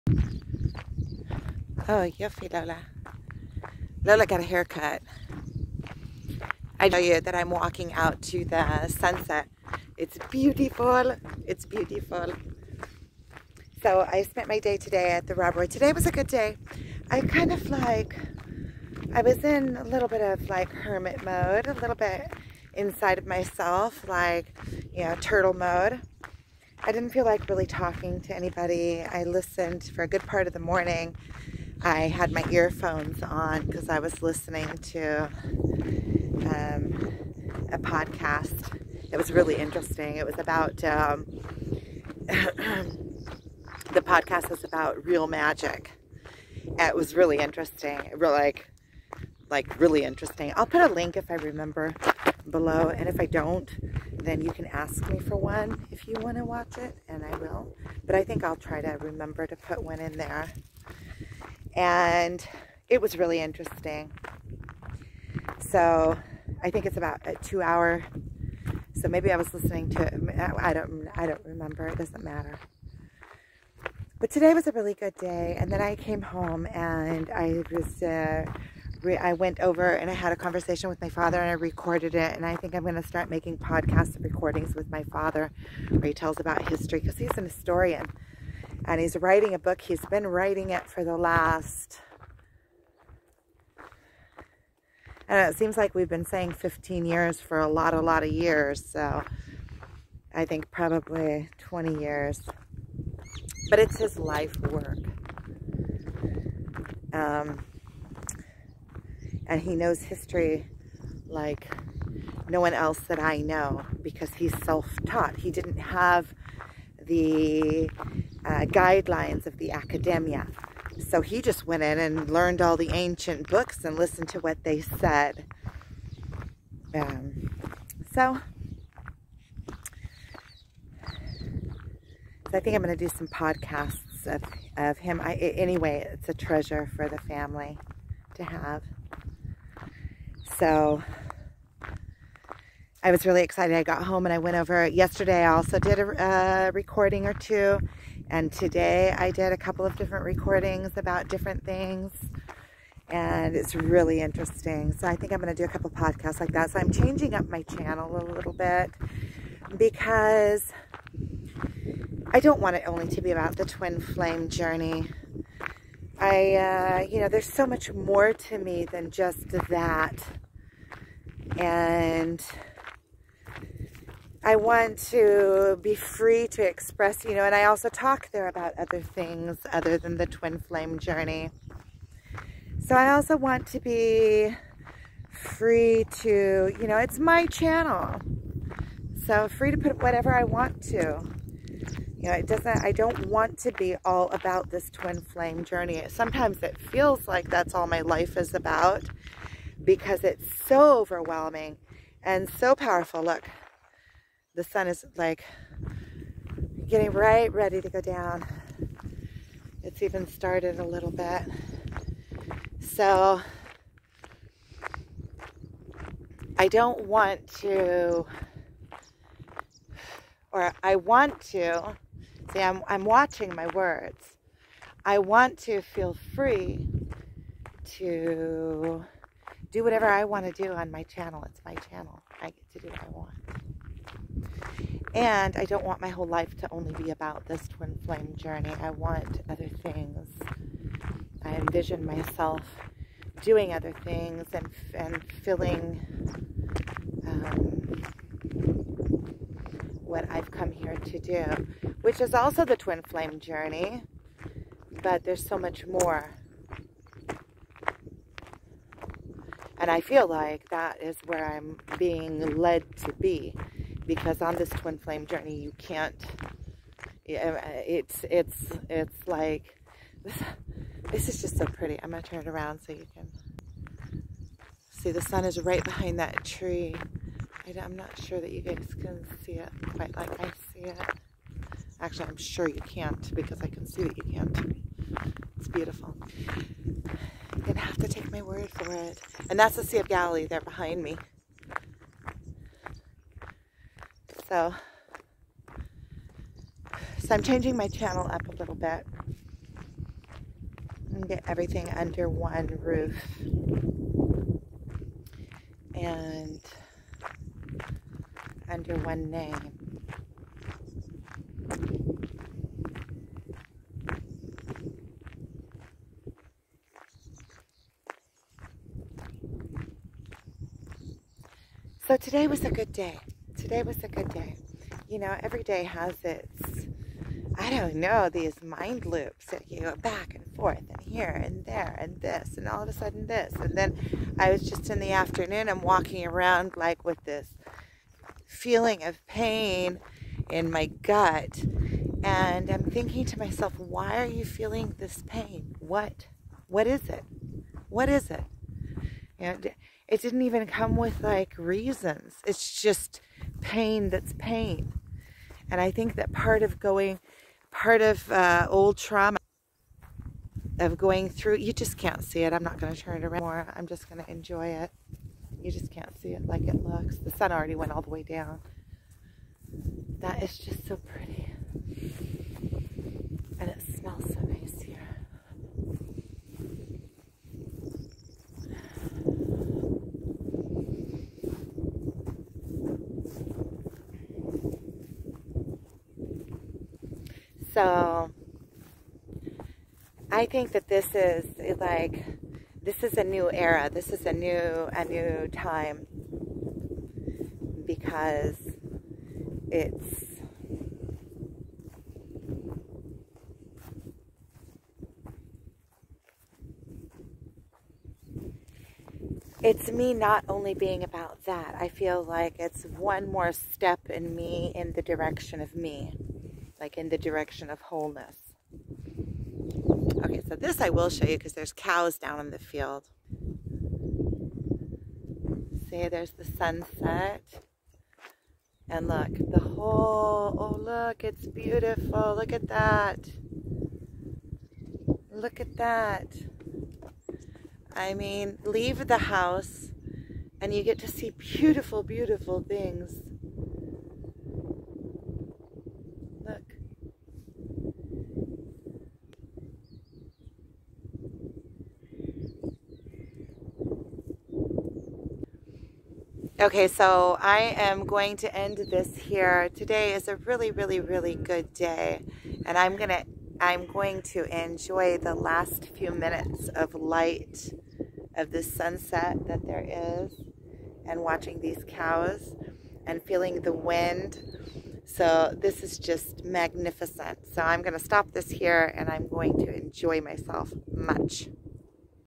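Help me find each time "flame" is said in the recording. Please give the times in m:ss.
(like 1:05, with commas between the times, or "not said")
2:43, 3:00, 3:15, 3:58, 4:13, 4:24.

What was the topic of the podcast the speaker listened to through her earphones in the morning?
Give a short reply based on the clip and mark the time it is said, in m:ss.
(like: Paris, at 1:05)
Real magic, at 0:45.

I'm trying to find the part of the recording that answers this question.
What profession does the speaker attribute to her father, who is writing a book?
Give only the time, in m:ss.
1:27.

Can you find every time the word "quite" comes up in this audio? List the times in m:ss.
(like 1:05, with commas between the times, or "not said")
4:39.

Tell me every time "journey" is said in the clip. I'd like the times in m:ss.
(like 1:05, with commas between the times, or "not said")
2:44, 3:00, 3:15, 3:58, 4:13, 4:25.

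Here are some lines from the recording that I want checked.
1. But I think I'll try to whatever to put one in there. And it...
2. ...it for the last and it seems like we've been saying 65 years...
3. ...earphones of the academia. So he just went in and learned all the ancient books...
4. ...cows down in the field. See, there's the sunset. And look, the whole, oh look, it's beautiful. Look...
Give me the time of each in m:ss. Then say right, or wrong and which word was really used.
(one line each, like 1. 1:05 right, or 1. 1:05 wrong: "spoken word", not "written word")
1. 0:58 wrong: "remember", not "whatever"
2. 1:30 wrong: "15", not "65"
3. 1:58 wrong: "guidelines", not "earphones"
4. 7:01 right.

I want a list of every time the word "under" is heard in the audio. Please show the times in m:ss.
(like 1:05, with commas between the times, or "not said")
5:01, 5:08.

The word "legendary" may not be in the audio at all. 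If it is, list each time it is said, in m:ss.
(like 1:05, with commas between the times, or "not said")
not said.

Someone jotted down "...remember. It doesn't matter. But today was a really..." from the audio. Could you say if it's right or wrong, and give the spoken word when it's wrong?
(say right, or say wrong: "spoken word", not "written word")
right.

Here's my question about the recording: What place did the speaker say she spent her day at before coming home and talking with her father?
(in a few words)
The Robbery.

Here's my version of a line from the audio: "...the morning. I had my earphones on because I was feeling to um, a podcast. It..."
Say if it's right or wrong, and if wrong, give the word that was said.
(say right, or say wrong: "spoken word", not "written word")
wrong: "listening", not "feeling".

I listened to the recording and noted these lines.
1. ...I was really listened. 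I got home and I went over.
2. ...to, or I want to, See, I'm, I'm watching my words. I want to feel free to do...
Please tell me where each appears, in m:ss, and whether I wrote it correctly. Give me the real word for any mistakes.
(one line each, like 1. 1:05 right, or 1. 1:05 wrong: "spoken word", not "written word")
1. 2:23 wrong: "excited", not "listened"
2. 3:37 right.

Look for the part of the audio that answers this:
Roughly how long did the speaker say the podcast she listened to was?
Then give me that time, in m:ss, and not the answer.
1:07.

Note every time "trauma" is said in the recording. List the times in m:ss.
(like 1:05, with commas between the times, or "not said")
5:58.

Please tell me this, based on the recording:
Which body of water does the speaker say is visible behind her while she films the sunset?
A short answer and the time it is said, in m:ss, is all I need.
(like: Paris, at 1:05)
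Sea of Galilee, at 4:49.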